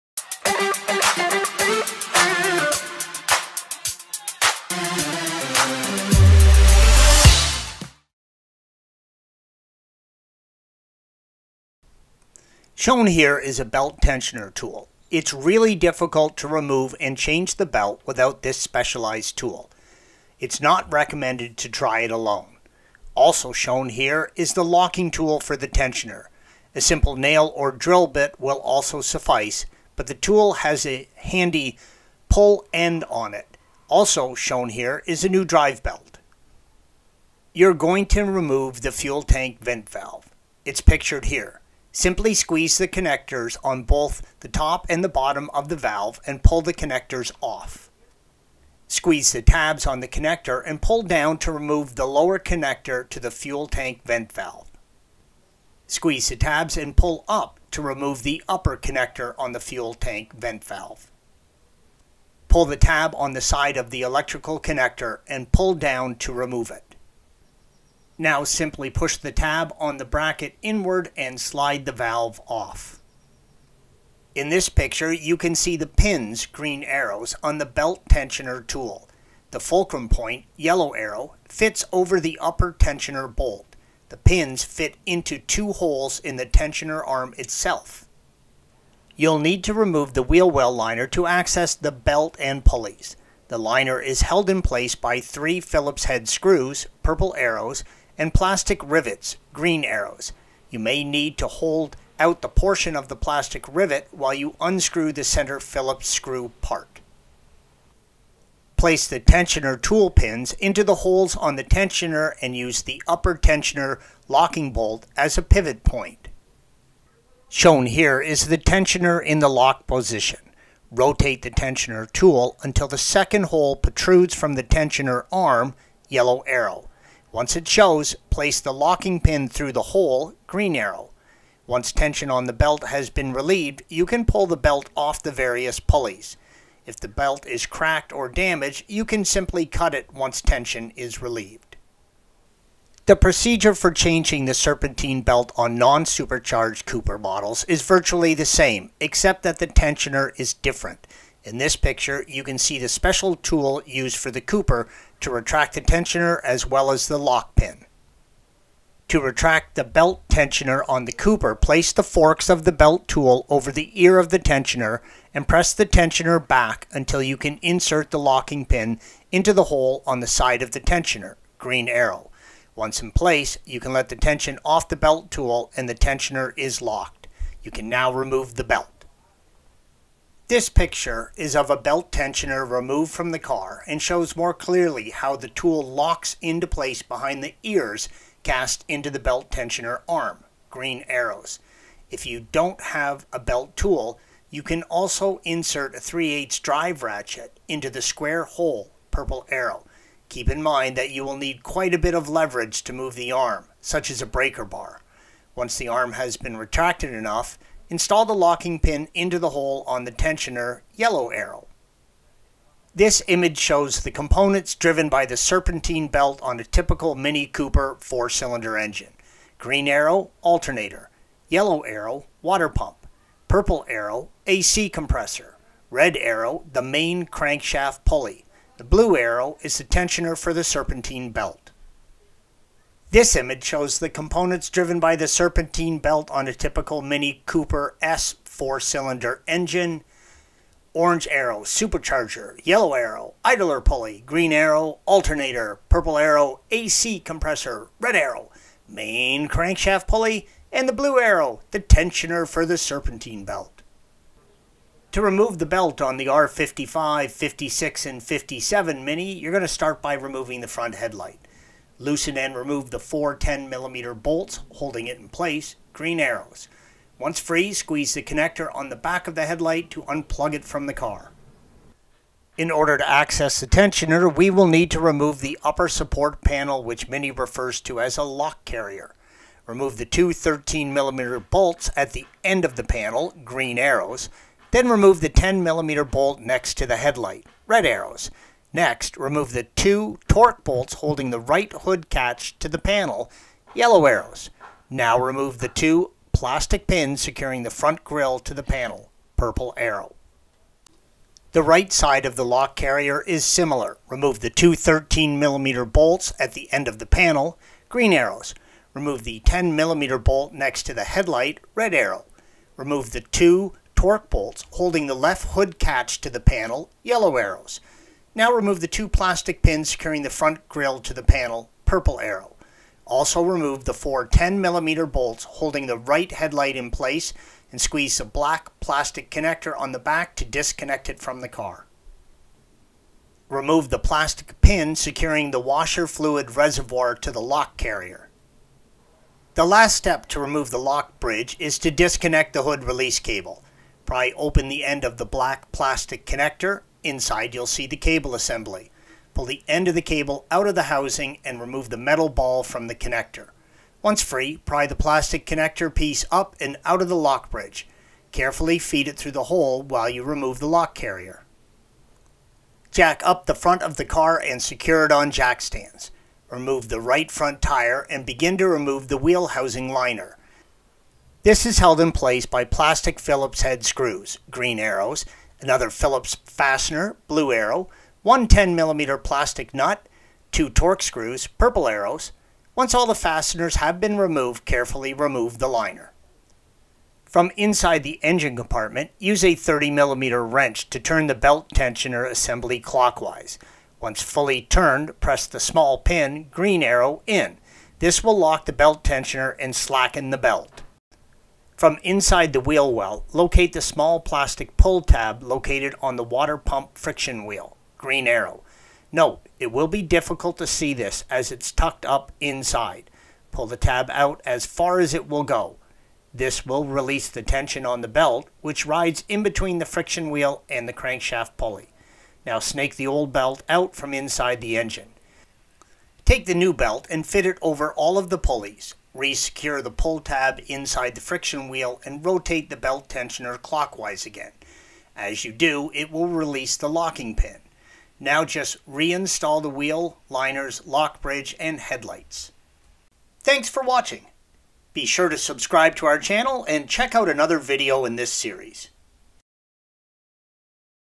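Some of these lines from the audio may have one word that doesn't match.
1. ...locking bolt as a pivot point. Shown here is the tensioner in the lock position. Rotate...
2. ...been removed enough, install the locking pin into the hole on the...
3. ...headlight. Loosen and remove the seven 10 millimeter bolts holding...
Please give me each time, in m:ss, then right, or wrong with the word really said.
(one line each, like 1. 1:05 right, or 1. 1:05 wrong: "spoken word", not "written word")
1. 1:54 right
2. 3:26 wrong: "retracted", not "removed"
3. 4:20 wrong: "four", not "seven".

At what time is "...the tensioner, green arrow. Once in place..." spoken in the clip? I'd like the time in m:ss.
2:50.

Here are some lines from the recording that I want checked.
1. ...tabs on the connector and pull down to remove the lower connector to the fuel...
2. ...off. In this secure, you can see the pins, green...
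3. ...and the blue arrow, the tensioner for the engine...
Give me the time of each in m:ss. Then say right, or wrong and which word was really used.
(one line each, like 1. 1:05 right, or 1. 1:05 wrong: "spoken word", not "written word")
1. 0:49 right
2. 1:12 wrong: "picture", not "secure"
3. 4:10 wrong: "serpentine", not "engine".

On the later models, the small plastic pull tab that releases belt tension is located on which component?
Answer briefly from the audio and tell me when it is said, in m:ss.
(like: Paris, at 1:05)
Water pump friction wheel, at 6:46.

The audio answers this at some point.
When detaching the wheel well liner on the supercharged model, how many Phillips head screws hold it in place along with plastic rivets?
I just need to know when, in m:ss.
1:35.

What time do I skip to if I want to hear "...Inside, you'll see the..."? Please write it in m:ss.
5:47.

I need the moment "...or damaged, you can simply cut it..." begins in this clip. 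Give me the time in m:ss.
2:18.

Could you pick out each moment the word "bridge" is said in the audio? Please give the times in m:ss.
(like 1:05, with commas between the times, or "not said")
5:41, 5:57, 7:21.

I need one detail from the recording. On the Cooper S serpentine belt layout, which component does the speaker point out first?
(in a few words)
Supercharger.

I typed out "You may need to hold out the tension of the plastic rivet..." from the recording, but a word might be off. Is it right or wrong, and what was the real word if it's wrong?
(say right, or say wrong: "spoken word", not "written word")
wrong: "portion", not "tension".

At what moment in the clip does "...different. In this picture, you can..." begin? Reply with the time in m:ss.
2:30.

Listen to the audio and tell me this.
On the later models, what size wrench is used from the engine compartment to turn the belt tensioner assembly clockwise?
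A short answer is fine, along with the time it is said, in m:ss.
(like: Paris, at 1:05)
30mm, at 6:29.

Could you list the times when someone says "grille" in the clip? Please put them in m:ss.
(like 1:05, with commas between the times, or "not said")
4:58, 5:20.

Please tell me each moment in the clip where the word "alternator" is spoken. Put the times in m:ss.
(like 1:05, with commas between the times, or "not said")
3:40, 4:05.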